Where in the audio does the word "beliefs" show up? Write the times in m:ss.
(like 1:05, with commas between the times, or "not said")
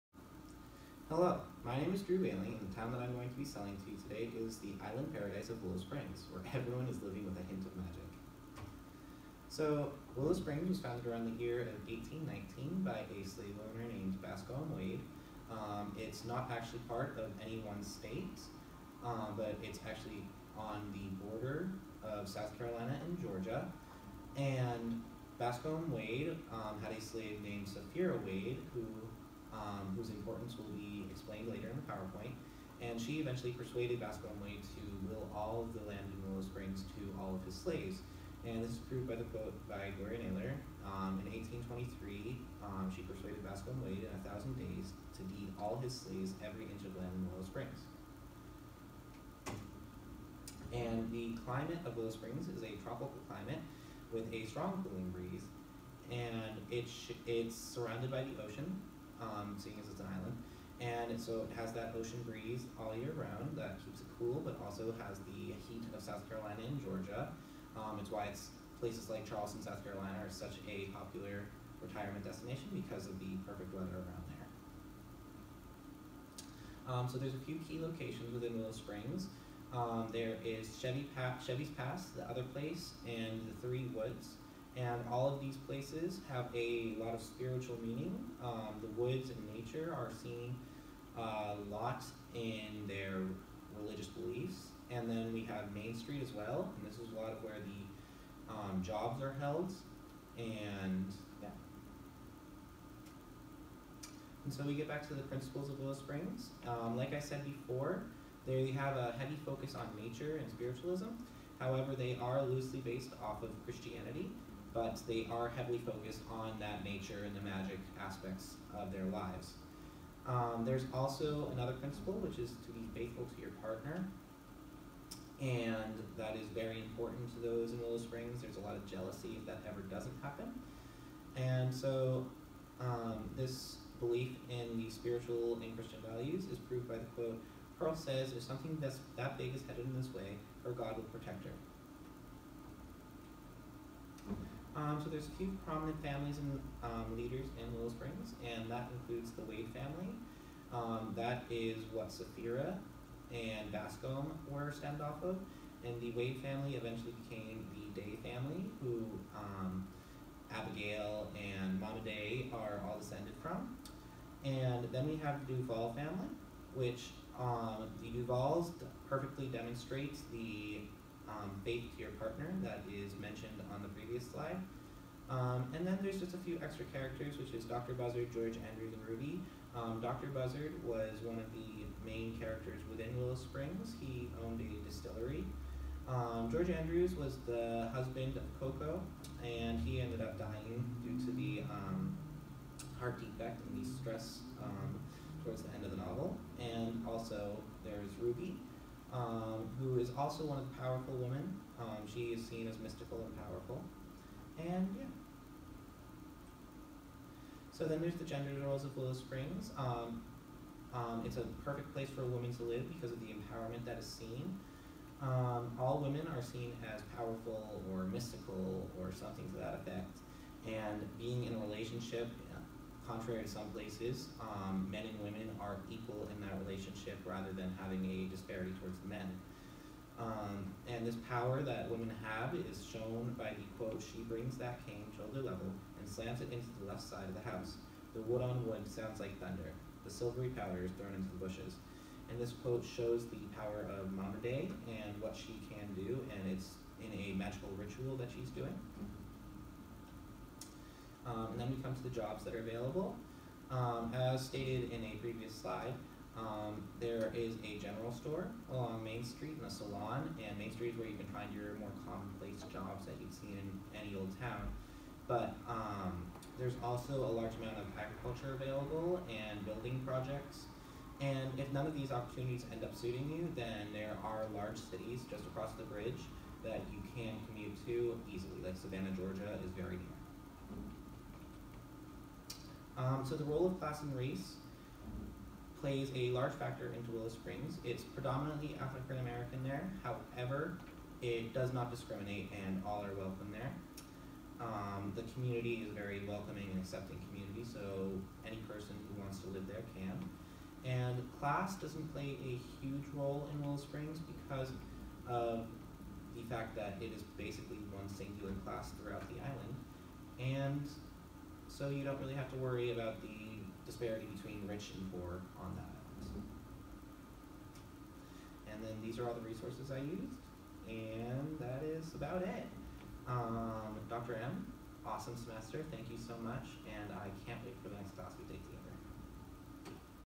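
1:34, 2:13.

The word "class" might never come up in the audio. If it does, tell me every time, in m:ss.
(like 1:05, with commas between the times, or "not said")
4:43, 5:01, 5:08, 5:28.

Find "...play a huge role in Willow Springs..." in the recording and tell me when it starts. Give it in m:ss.
5:02.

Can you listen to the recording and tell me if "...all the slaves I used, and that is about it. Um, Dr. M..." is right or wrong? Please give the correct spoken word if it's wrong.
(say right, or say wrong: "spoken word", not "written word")
wrong: "resources", not "slaves".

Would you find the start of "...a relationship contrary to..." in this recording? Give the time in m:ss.
3:41.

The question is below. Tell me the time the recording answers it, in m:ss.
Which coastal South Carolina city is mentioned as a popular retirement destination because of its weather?
1:09.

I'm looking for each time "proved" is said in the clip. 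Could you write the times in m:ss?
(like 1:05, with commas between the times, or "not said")
0:38, 2:16.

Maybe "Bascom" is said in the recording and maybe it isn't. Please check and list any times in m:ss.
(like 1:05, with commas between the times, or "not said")
0:14, 0:25, 0:33, 0:43, 2:33.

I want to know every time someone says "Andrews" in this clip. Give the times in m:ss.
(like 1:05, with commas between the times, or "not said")
2:58, 3:06.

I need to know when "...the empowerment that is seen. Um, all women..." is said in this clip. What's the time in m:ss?
3:33.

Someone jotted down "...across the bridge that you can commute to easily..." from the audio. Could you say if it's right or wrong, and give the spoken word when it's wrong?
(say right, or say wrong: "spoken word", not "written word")
right.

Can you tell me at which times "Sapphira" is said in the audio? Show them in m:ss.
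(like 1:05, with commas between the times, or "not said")
0:27, 2:32.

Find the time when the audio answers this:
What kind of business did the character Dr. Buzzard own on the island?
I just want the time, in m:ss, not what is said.
3:04.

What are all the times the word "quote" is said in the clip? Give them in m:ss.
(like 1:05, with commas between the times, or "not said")
0:39, 2:17, 3:53, 4:02.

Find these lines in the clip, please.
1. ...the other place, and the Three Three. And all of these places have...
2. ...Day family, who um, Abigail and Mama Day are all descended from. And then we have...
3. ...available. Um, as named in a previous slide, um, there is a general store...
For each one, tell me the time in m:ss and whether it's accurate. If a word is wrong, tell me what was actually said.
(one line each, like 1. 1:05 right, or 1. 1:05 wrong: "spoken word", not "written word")
1. 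1:22 wrong: "Woods", not "Three"
2. 2:38 right
3. 4:12 wrong: "stated", not "named".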